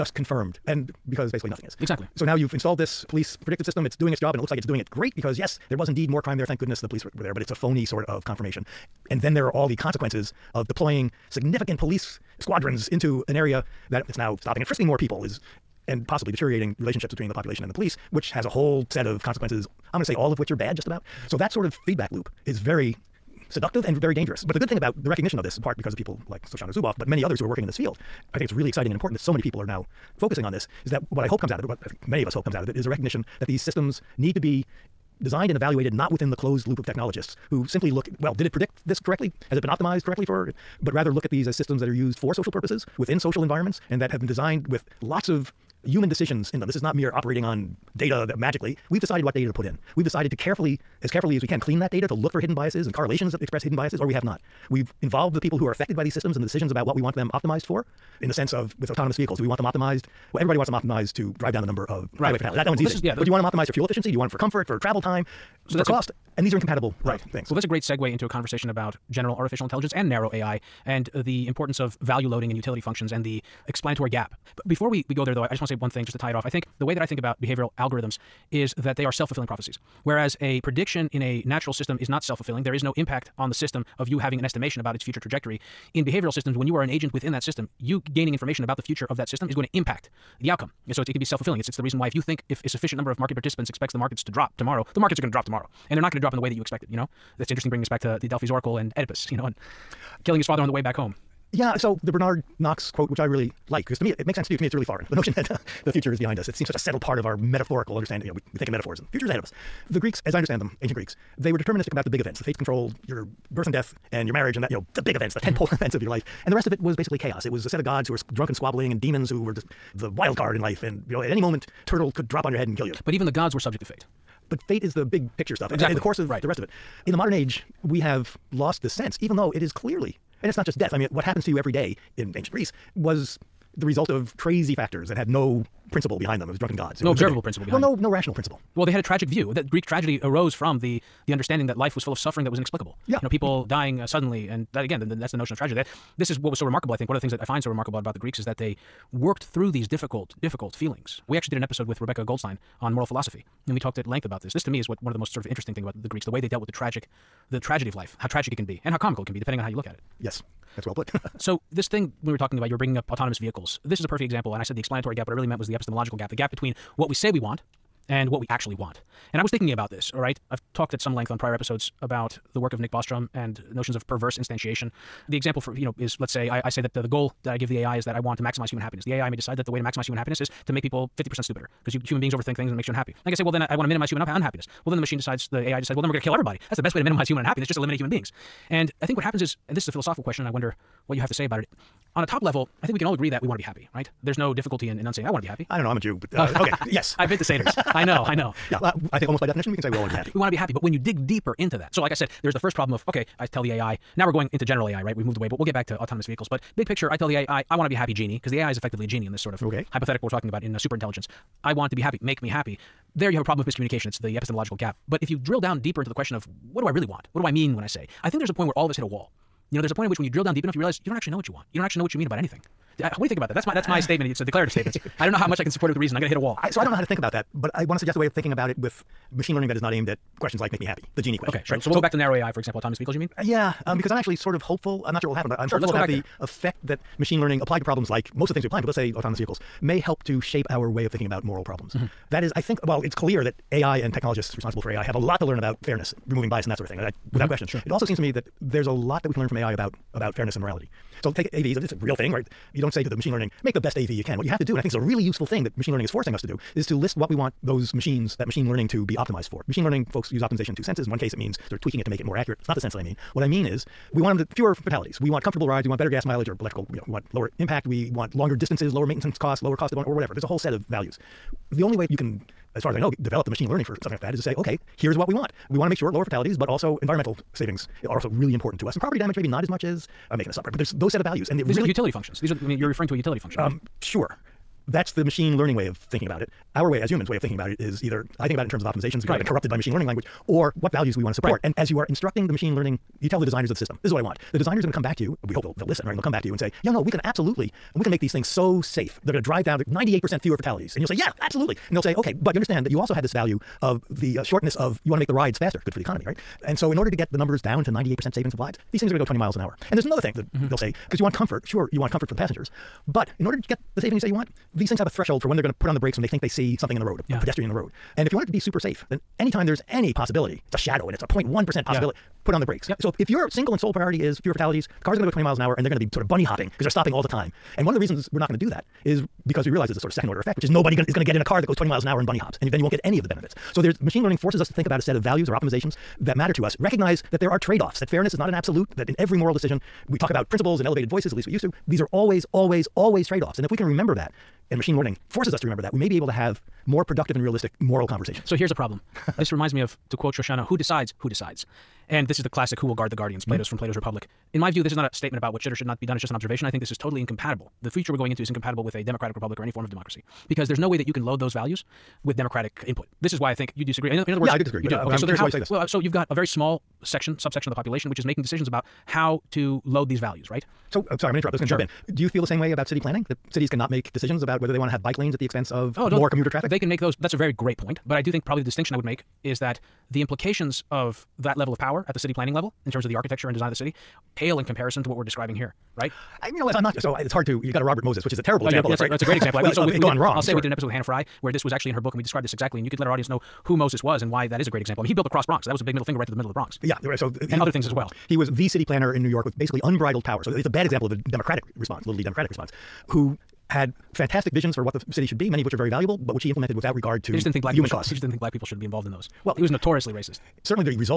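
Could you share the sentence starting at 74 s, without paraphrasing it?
But before we, we go there, though, I, I just want to say one thing just to tie it off.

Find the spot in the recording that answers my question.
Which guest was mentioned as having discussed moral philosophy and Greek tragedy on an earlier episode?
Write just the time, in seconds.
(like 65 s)
152 s.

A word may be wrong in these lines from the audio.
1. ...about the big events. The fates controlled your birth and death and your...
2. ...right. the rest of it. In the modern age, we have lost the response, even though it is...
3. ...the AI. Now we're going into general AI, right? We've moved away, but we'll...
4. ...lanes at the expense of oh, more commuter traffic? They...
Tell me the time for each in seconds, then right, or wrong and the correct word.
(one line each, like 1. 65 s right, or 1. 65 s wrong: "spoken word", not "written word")
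1. 111 s right
2. 126 s wrong: "sense", not "response"
3. 203 s right
4. 375 s right.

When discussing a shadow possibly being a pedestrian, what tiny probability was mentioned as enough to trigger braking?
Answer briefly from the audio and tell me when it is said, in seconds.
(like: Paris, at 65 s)
0.1%, at 321 s.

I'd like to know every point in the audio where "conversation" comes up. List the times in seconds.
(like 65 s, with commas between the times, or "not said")
68 s, 348 s.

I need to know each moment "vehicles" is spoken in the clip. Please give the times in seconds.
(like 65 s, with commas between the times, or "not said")
59 s, 163 s, 206 s, 232 s, 239 s.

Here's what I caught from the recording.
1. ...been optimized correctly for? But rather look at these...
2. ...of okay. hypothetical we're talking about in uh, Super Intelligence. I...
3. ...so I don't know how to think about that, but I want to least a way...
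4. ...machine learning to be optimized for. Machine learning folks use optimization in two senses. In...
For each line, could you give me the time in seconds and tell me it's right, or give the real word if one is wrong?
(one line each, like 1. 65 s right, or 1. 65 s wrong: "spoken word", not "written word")
1. 39 s right
2. 209 s right
3. 226 s wrong: "suggest", not "least"
4. 258 s right.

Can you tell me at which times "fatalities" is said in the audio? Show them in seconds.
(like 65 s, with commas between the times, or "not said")
62 s, 264 s, 276 s, 300 s, 324 s.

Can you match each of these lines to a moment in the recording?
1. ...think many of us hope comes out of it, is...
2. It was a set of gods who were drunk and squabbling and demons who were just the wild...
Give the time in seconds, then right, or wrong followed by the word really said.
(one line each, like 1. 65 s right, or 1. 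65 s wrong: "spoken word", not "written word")
1. 31 s right
2. 117 s right.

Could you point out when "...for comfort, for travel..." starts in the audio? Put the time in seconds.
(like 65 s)
64 s.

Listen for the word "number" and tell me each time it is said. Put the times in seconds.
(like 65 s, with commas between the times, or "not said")
61 s, 92 s, 307 s.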